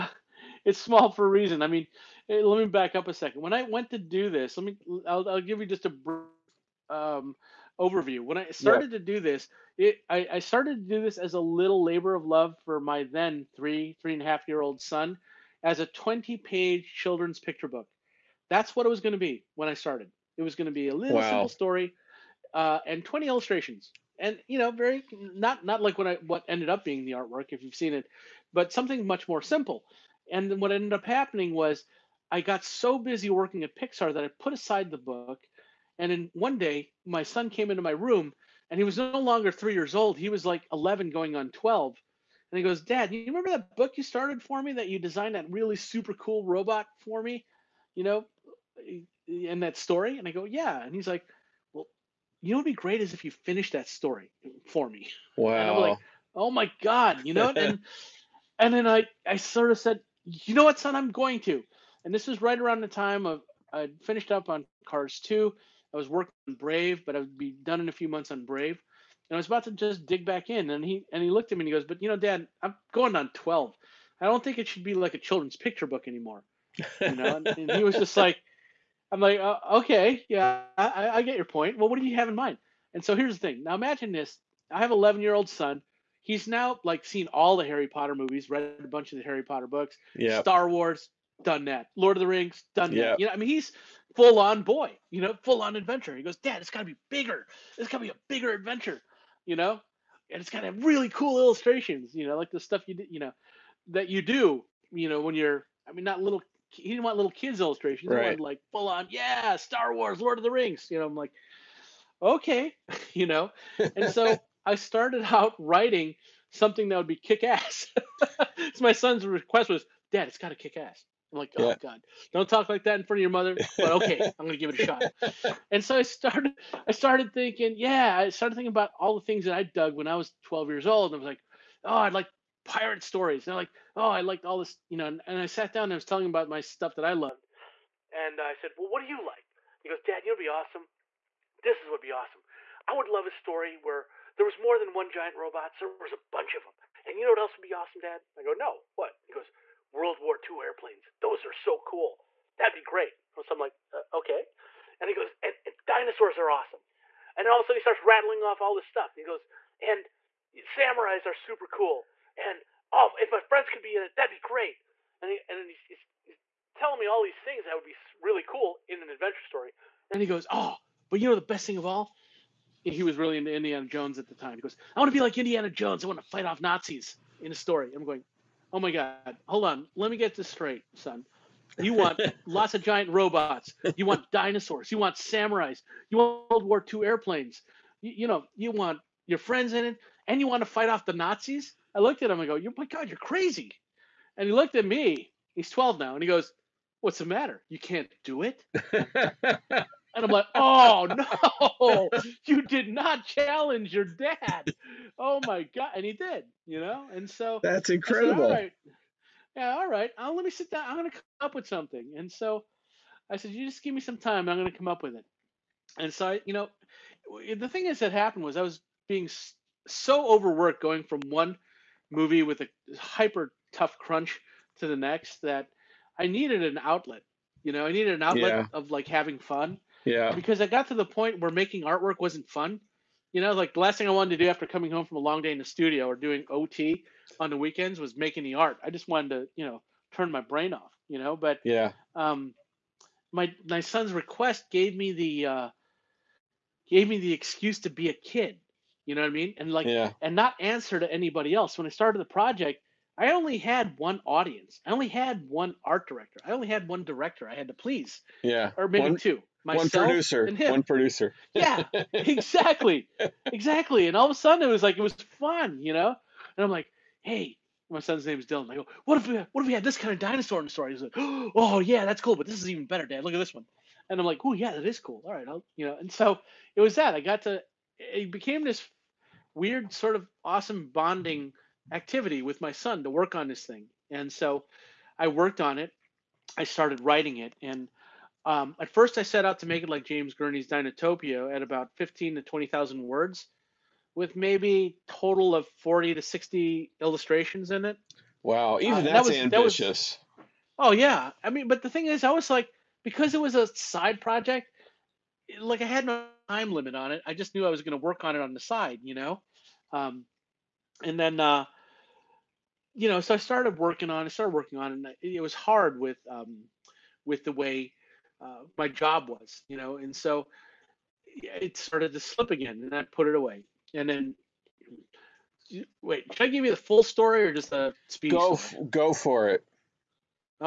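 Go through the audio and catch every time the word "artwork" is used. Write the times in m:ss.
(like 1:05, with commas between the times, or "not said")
0:27, 3:51.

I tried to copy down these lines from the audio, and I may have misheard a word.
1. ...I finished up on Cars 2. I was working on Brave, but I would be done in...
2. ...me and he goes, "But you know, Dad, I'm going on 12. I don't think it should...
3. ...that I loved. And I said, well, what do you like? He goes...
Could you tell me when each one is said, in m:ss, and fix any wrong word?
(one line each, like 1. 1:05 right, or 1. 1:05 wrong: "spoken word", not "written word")
1. 1:03 right
2. 1:11 right
3. 2:16 right.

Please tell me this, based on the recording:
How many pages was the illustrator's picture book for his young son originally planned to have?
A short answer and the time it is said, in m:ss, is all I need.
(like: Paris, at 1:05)
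20, at 0:15.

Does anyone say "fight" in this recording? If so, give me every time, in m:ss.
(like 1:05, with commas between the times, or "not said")
2:56, 3:10.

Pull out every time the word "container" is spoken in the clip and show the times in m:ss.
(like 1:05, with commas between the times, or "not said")
not said.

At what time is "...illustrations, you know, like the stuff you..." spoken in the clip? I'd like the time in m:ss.
1:41.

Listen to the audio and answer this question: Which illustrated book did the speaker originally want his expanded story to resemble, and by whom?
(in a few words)
James Gurney's Dinotopia.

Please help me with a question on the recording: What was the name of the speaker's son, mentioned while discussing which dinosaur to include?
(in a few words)
Dylan.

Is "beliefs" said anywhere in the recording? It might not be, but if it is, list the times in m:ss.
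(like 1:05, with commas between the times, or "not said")
not said.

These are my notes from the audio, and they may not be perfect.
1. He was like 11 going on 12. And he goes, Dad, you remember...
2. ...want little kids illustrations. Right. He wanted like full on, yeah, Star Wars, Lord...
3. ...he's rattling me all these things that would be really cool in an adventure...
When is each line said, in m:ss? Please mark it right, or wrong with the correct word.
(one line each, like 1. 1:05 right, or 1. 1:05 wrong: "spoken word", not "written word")
1. 0:40 right
2. 1:47 right
3. 2:46 wrong: "telling", not "rattling".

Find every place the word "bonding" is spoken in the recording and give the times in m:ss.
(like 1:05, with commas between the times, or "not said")
4:40.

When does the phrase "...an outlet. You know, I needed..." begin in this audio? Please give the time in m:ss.
3:46.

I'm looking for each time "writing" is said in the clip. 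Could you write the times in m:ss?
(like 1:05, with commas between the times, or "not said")
1:55, 4:47.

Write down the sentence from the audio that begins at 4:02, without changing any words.
Um my my son's request gave me the uh gave me the excuse to be a kid.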